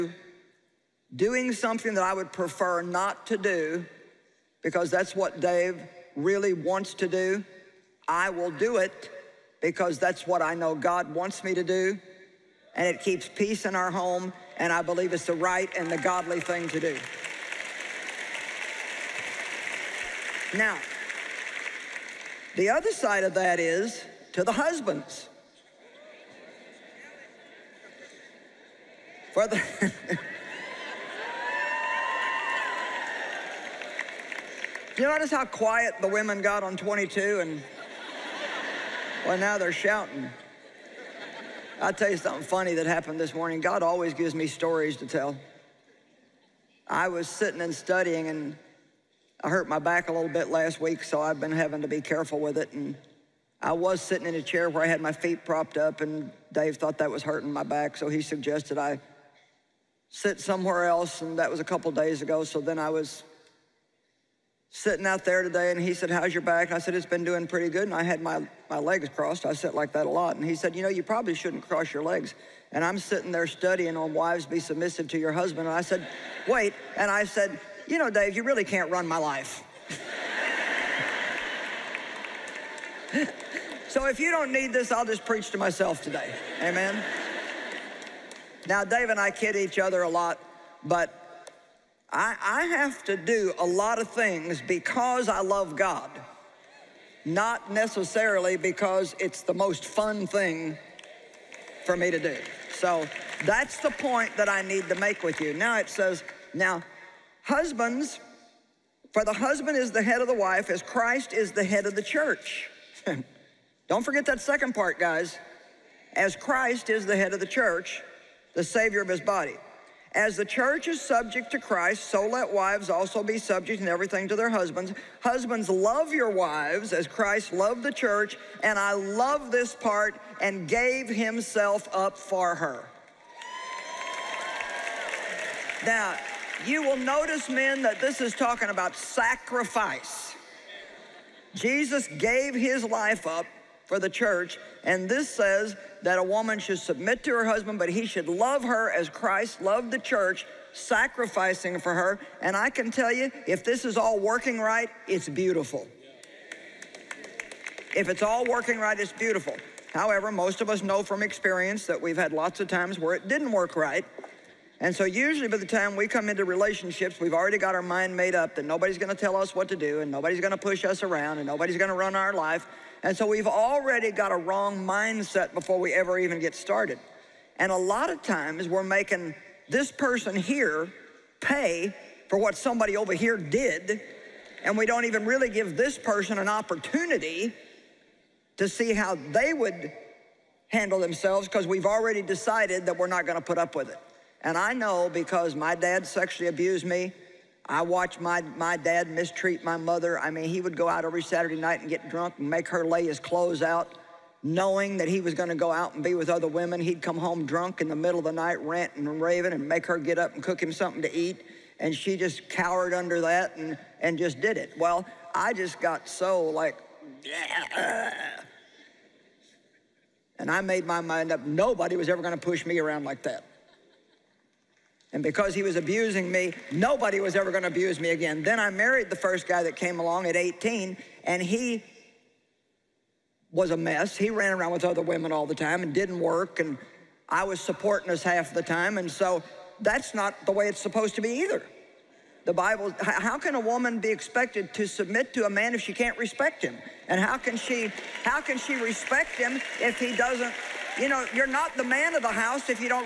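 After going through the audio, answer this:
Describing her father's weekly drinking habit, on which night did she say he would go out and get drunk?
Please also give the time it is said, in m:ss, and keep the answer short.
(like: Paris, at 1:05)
Saturday night, at 3:21.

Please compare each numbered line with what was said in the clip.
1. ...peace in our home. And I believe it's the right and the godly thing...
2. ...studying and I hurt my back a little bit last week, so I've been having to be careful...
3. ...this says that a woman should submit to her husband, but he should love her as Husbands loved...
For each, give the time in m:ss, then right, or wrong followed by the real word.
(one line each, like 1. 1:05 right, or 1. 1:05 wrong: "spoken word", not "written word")
1. 0:13 right
2. 0:47 right
3. 2:25 wrong: "Christ", not "Husbands".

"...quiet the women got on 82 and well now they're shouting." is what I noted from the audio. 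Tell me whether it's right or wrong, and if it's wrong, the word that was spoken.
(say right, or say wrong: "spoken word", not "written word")
wrong: "22", not "82".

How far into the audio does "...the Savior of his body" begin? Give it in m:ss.
1:58.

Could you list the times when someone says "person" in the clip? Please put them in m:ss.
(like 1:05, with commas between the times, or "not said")
2:59, 3:05.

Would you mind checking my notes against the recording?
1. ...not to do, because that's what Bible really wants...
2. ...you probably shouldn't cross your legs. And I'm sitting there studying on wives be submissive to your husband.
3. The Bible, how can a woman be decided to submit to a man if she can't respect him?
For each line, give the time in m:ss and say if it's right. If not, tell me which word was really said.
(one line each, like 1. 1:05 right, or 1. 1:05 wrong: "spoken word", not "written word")
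1. 0:02 wrong: "Dave", not "Bible"
2. 1:10 right
3. 4:02 wrong: "expected", not "decided".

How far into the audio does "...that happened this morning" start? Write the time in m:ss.
0:42.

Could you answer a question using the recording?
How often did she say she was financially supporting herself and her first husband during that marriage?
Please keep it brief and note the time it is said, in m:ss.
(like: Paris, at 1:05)
half the time, at 3:58.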